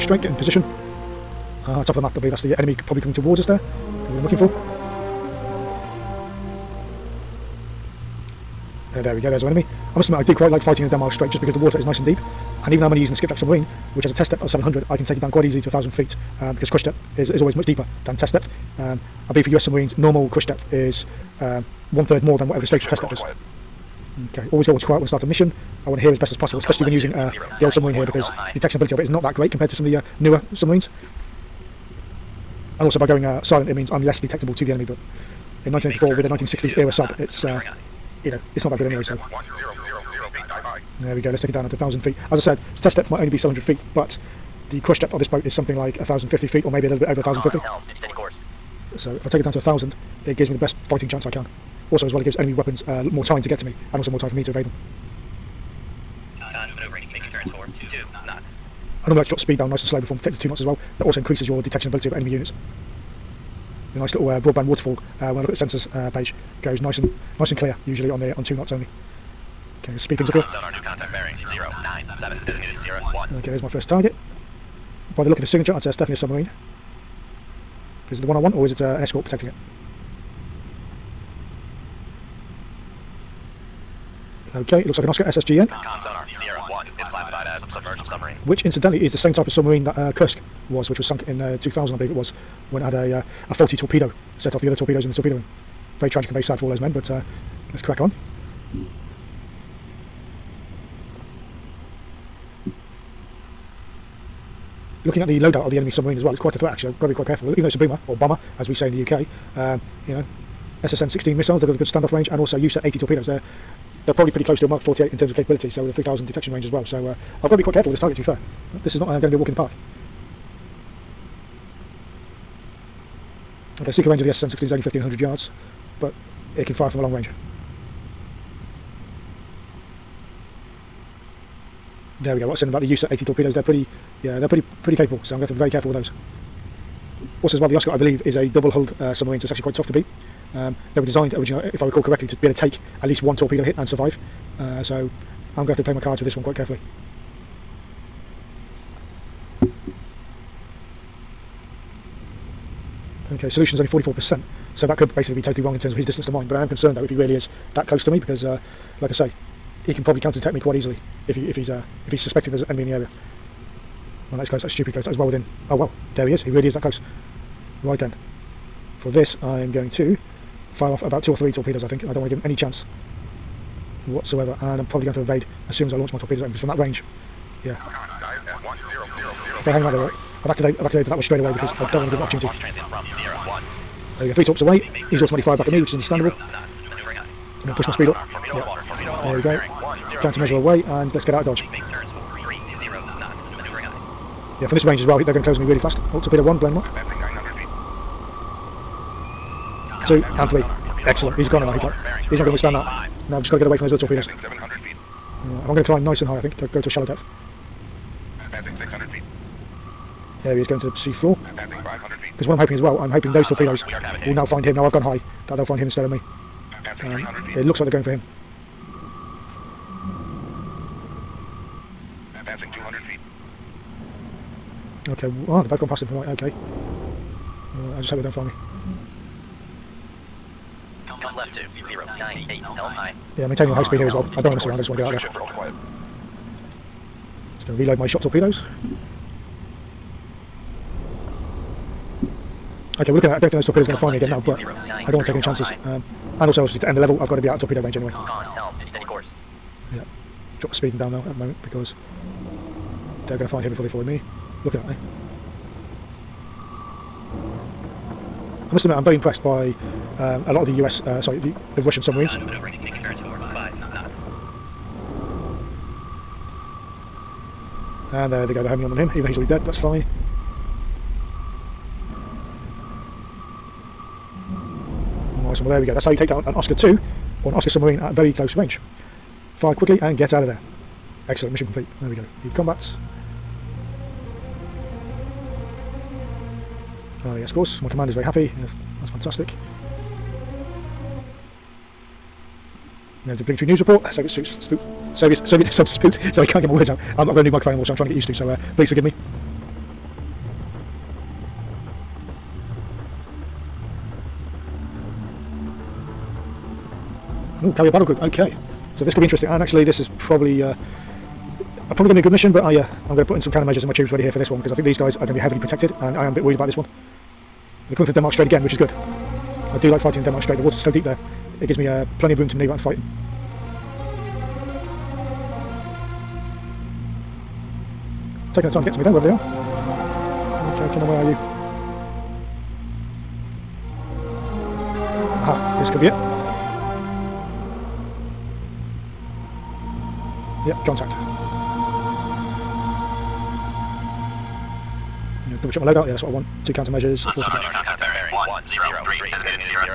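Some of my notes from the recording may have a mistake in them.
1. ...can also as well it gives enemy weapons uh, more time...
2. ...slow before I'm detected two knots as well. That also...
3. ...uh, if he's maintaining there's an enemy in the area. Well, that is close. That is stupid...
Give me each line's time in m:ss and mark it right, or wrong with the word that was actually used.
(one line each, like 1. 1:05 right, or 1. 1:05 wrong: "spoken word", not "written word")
1. 0:51 right
2. 0:59 right
3. 2:41 wrong: "suspecting", not "maintaining".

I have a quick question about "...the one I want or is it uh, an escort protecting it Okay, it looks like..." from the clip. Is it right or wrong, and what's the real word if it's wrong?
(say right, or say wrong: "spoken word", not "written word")
right.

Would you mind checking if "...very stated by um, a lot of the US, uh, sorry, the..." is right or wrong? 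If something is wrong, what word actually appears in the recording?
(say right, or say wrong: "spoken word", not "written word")
wrong: "impressed", not "stated".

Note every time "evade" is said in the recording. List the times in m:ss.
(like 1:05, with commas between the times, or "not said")
0:54, 2:55.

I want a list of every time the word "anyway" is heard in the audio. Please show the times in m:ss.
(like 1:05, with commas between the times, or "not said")
0:38, 4:07.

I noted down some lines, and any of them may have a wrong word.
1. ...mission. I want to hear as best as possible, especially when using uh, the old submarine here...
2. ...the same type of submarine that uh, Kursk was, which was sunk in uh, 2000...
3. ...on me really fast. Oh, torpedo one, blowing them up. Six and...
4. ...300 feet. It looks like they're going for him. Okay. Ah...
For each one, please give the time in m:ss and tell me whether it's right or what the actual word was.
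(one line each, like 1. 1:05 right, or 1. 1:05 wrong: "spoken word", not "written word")
1. 0:25 right
2. 1:29 right
3. 3:15 wrong: "Two", not "Six"
4. 3:37 right.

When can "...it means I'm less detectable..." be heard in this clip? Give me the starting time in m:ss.
0:33.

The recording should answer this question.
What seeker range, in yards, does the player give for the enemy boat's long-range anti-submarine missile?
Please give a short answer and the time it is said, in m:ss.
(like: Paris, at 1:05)
1500 yards, at 2:04.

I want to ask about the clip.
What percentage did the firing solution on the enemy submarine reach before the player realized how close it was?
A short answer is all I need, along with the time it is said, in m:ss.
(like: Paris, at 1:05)
44%, at 2:33.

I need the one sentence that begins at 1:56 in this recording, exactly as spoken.
So uh, I've got to be quite careful with this target, to be fair.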